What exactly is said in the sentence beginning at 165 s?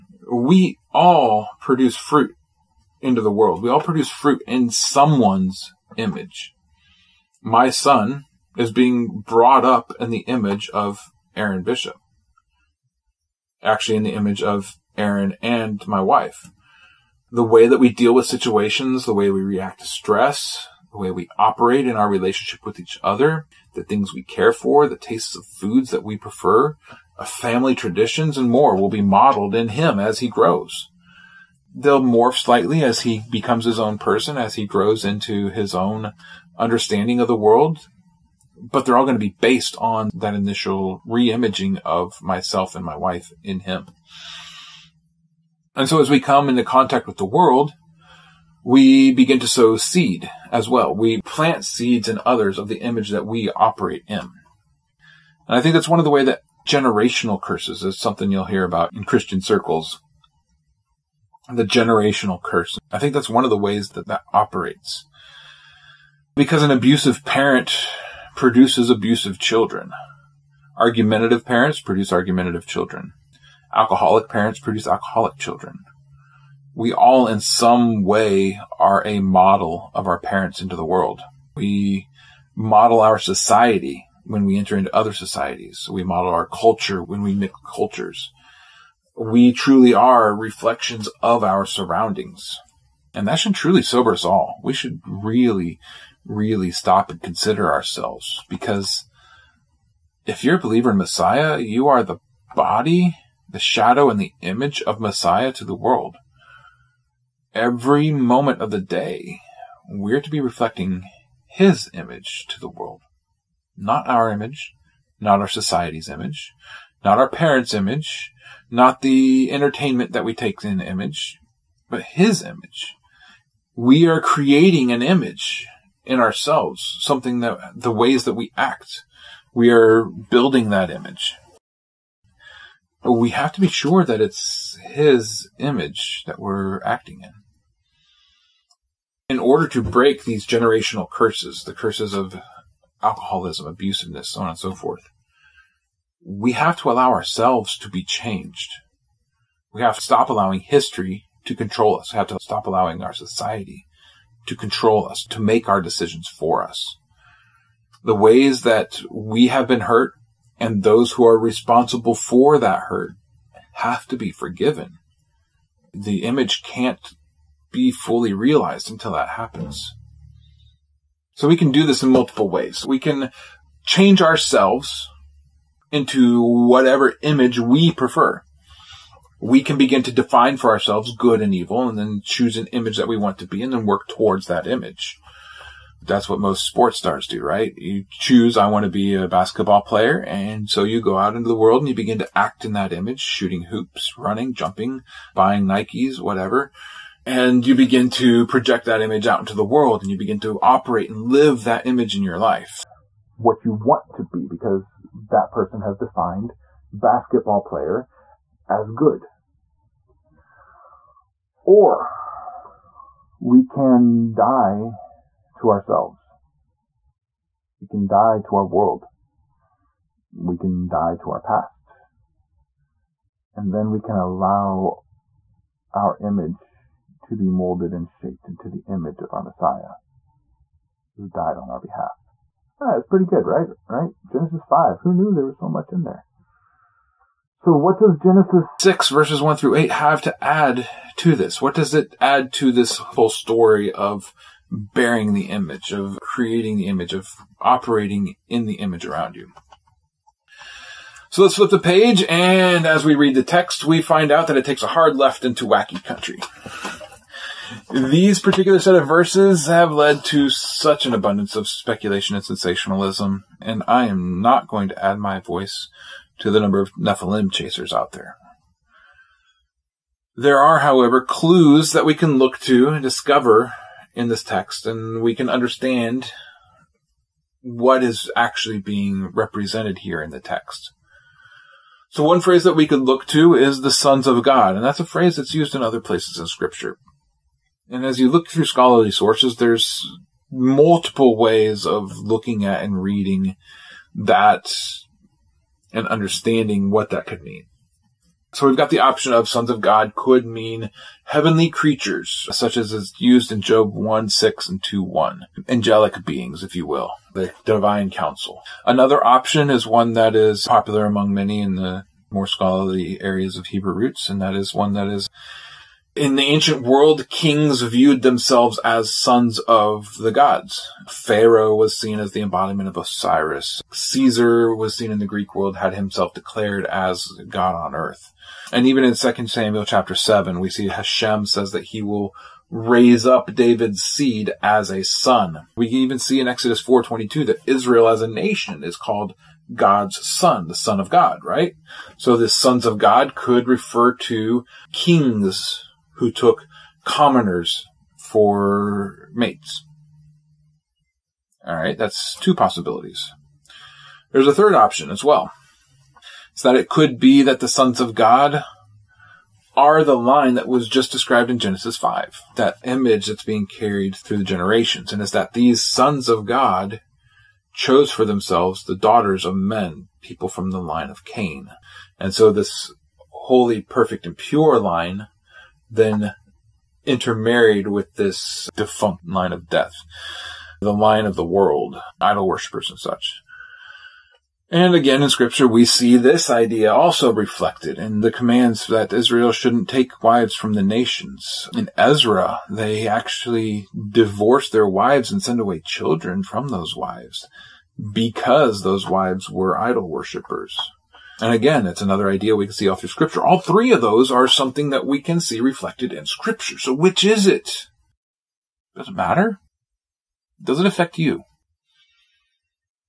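The image can't be fully realized until that happens.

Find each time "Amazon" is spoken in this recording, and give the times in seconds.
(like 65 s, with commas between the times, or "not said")
not said.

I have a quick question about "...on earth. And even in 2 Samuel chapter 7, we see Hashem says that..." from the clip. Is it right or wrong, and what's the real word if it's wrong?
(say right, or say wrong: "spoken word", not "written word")
right.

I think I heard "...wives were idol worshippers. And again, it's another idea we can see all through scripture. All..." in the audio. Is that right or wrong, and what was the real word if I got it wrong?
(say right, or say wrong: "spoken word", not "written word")
right.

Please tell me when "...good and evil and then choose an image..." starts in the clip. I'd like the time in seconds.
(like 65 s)
181 s.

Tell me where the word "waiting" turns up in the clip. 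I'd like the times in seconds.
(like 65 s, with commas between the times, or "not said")
not said.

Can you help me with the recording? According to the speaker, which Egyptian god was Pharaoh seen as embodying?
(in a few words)
Osiris.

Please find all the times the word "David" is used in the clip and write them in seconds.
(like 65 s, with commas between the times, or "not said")
333 s.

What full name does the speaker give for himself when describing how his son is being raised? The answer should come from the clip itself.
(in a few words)
Aaron Bishop.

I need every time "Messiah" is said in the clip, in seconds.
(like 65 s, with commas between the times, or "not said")
100 s, 104 s, 229 s.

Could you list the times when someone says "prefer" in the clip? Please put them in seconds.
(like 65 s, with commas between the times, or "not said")
26 s, 177 s.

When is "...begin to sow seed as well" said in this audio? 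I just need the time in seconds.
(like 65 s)
49 s.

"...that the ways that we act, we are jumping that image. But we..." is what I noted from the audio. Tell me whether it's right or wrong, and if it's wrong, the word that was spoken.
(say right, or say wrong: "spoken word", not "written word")
wrong: "building", not "jumping".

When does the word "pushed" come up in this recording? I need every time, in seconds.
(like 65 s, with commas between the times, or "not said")
not said.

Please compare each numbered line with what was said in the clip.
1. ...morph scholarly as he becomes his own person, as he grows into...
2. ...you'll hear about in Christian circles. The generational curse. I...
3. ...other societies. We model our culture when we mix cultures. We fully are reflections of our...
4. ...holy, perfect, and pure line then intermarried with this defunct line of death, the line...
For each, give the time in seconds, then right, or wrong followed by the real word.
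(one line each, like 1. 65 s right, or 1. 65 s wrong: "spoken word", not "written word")
1. 31 s wrong: "slightly", not "scholarly"
2. 58 s right
3. 84 s wrong: "truly", not "fully"
4. 373 s right.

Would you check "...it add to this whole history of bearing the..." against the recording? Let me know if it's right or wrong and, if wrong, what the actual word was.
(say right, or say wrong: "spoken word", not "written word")
wrong: "story", not "history".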